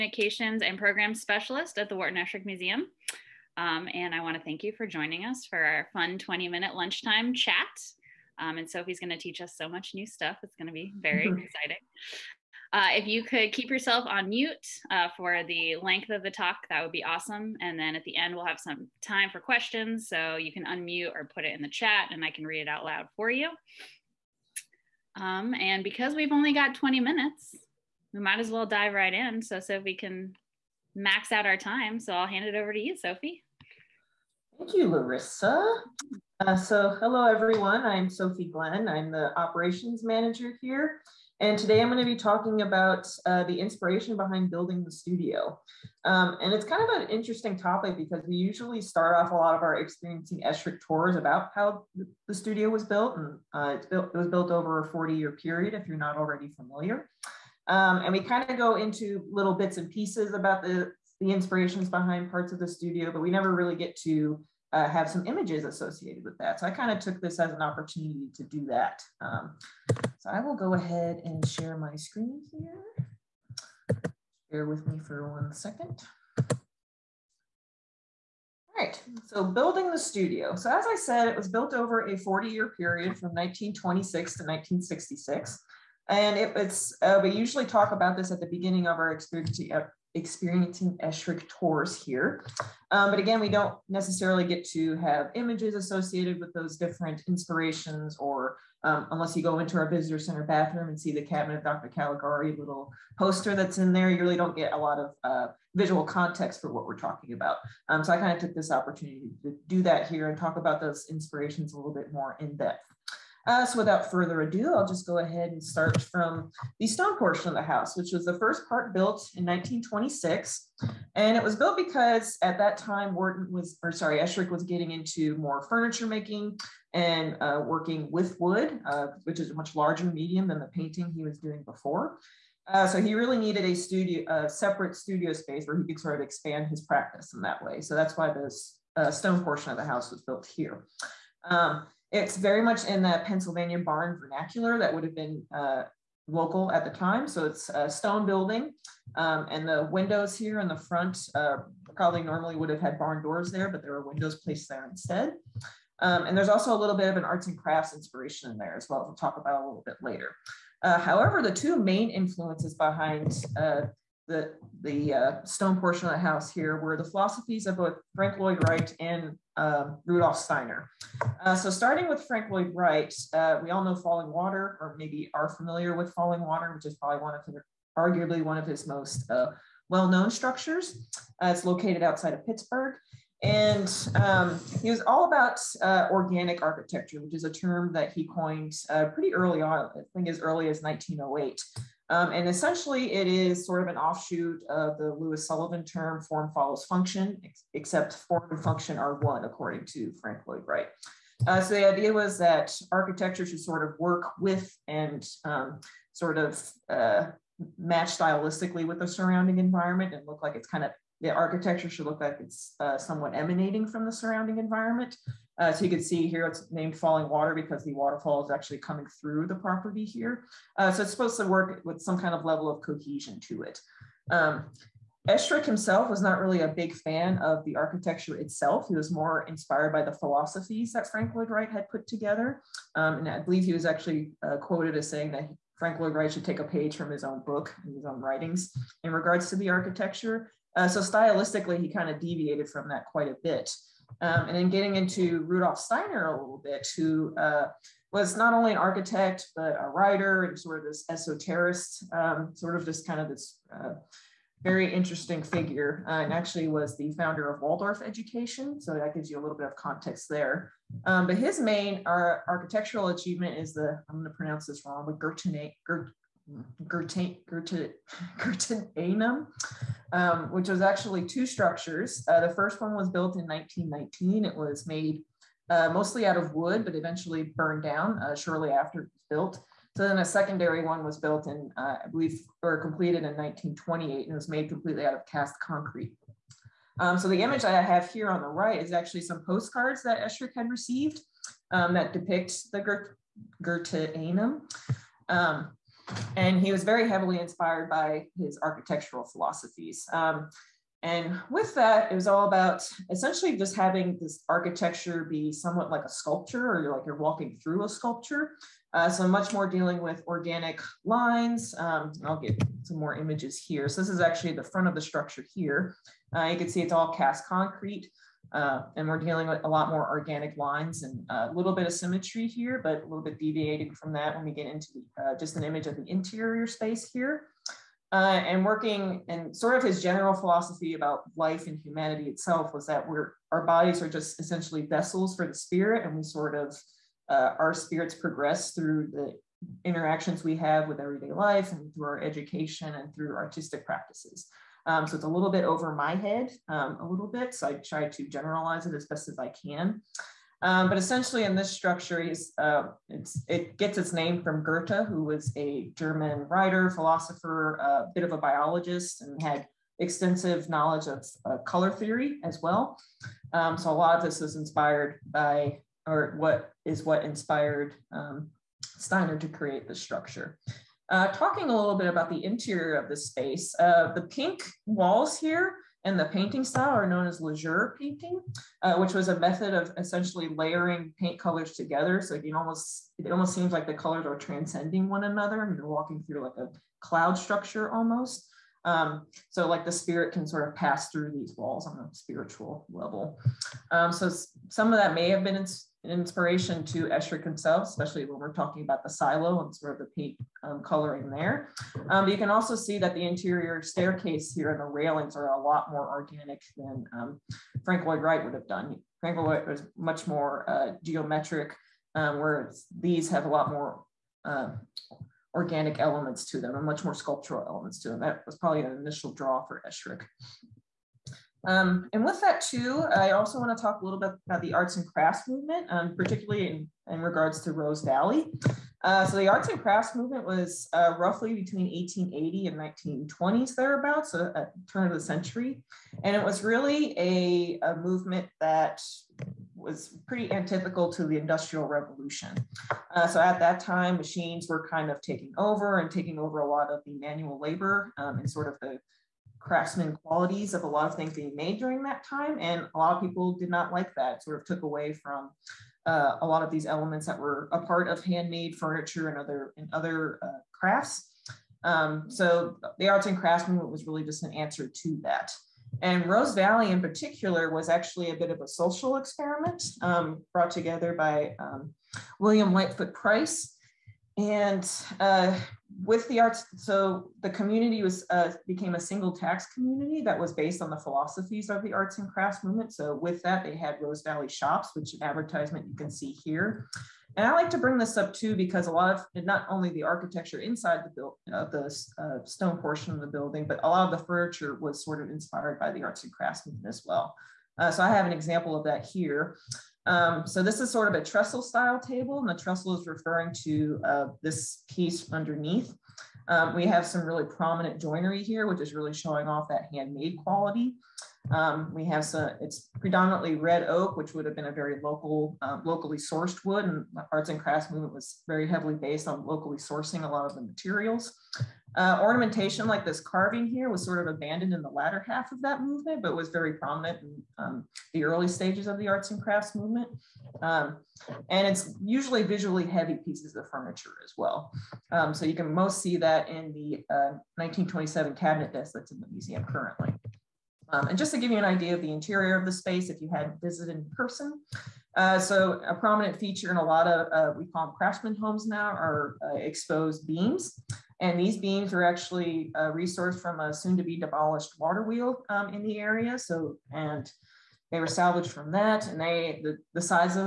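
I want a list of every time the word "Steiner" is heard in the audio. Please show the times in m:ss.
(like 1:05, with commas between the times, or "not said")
2:50, 4:05, 6:08.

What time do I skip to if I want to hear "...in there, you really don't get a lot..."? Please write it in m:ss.
1:43.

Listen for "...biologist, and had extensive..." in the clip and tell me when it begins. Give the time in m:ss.
5:58.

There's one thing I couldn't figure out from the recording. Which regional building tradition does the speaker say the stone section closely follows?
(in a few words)
Pennsylvania barn vernacular.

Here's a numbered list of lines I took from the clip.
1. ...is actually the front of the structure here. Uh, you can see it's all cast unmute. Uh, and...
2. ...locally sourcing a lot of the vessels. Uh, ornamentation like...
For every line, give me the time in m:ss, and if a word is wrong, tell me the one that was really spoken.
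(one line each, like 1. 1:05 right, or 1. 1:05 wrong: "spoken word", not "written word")
1. 5:14 wrong: "concrete", not "unmute"
2. 8:39 wrong: "materials", not "vessels".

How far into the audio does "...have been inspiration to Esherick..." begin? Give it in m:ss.
6:35.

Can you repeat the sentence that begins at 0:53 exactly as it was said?
And uh, built, it was built over a 40 year period, if you're not already familiar.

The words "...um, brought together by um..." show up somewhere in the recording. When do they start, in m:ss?
7:50.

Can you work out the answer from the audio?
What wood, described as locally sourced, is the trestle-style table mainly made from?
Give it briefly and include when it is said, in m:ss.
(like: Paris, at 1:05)
red oak, at 8:33.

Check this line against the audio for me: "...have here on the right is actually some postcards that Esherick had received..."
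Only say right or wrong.
right.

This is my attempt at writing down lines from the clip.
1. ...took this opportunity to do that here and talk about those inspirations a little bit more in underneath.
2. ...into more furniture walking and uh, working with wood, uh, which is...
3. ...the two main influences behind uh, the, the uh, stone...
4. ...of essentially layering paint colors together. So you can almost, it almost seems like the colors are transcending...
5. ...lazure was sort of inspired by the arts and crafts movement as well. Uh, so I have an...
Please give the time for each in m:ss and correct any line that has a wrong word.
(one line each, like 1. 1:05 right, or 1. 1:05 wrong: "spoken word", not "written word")
1. 1:48 wrong: "depth", not "underneath"
2. 2:04 wrong: "making", not "walking"
3. 2:41 right
4. 6:19 right
5. 8:14 wrong: "furniture", not "lazure".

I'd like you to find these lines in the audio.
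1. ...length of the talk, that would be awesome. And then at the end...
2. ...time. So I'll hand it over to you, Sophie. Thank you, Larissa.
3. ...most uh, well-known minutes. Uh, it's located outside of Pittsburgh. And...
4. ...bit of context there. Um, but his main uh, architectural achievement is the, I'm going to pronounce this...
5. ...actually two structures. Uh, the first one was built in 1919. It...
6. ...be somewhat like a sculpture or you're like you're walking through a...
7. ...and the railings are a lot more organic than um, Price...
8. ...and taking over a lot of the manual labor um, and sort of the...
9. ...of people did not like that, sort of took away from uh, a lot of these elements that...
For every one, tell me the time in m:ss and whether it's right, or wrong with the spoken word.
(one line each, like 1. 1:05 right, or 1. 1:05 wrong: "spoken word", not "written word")
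1. 0:15 right
2. 0:31 right
3. 2:58 wrong: "structures", not "minutes"
4. 4:19 right
5. 4:30 right
6. 5:05 right
7. 6:44 wrong: "Frank", not "Price"
8. 7:26 right
9. 7:33 right.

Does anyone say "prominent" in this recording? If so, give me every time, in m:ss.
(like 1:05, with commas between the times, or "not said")
8:27, 8:46, 9:05.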